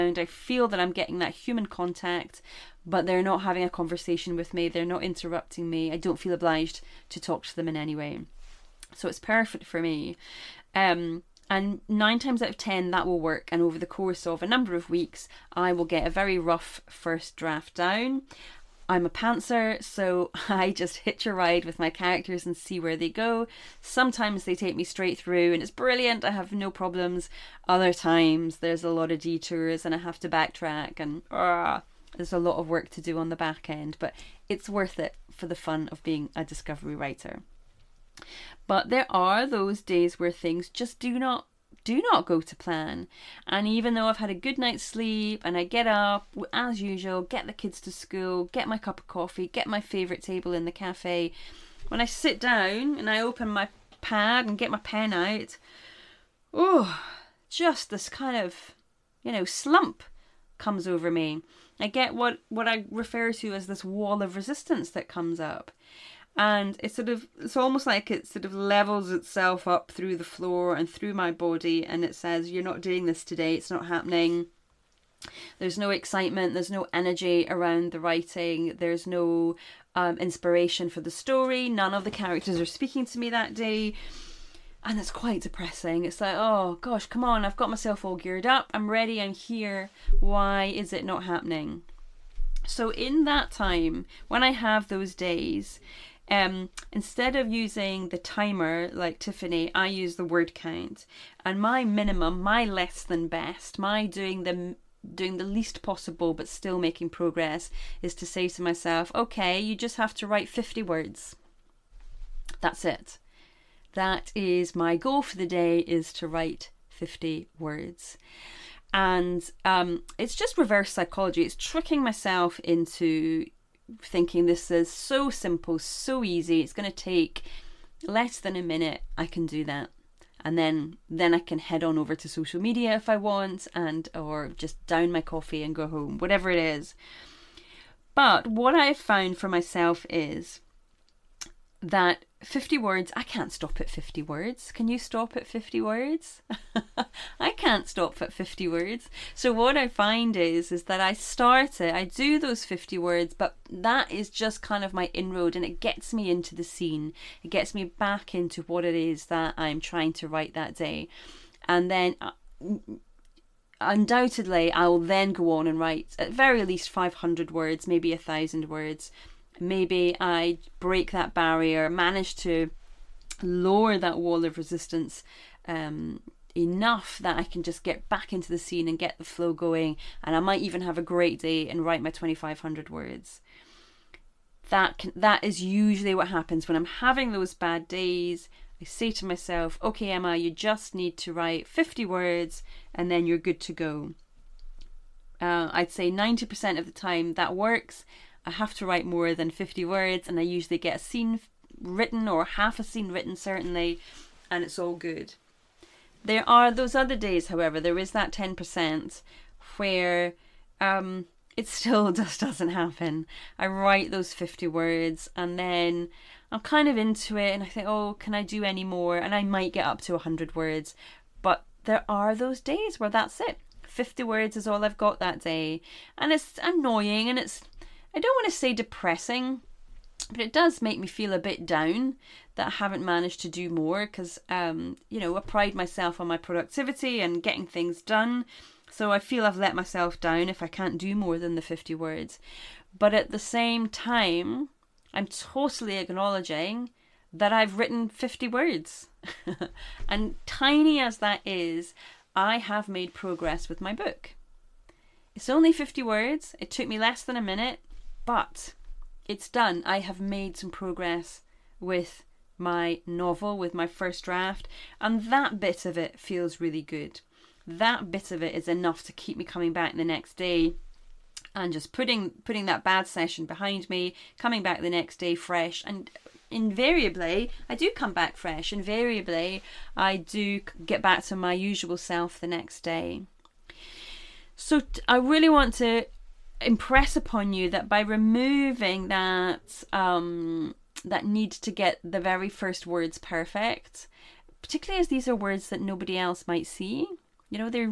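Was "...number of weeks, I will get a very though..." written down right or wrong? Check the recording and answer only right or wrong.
wrong.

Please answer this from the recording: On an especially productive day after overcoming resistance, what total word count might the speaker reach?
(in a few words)
2,500 words.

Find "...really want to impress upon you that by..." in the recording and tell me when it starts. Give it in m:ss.
4:45.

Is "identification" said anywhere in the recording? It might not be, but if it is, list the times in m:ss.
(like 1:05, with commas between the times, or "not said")
not said.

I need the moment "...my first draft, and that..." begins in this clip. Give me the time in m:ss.
4:23.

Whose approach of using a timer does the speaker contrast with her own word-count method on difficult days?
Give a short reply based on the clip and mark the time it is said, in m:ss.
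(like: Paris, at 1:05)
Tiffany, at 1:39.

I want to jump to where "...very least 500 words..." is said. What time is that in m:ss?
2:46.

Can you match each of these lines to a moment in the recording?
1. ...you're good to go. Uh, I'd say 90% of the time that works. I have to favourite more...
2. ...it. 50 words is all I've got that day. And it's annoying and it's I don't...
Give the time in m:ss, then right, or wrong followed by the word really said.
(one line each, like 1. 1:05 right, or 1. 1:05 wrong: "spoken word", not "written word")
1. 3:13 wrong: "write", not "favourite"
2. 3:43 right.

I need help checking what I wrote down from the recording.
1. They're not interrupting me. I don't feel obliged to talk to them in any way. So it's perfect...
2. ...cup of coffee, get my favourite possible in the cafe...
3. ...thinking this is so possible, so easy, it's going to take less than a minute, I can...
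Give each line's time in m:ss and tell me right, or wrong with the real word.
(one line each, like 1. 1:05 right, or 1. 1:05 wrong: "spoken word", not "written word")
1. 0:04 right
2. 0:48 wrong: "table", not "possible"
3. 2:04 wrong: "simple", not "possible".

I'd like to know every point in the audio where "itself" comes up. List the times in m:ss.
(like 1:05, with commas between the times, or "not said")
1:09.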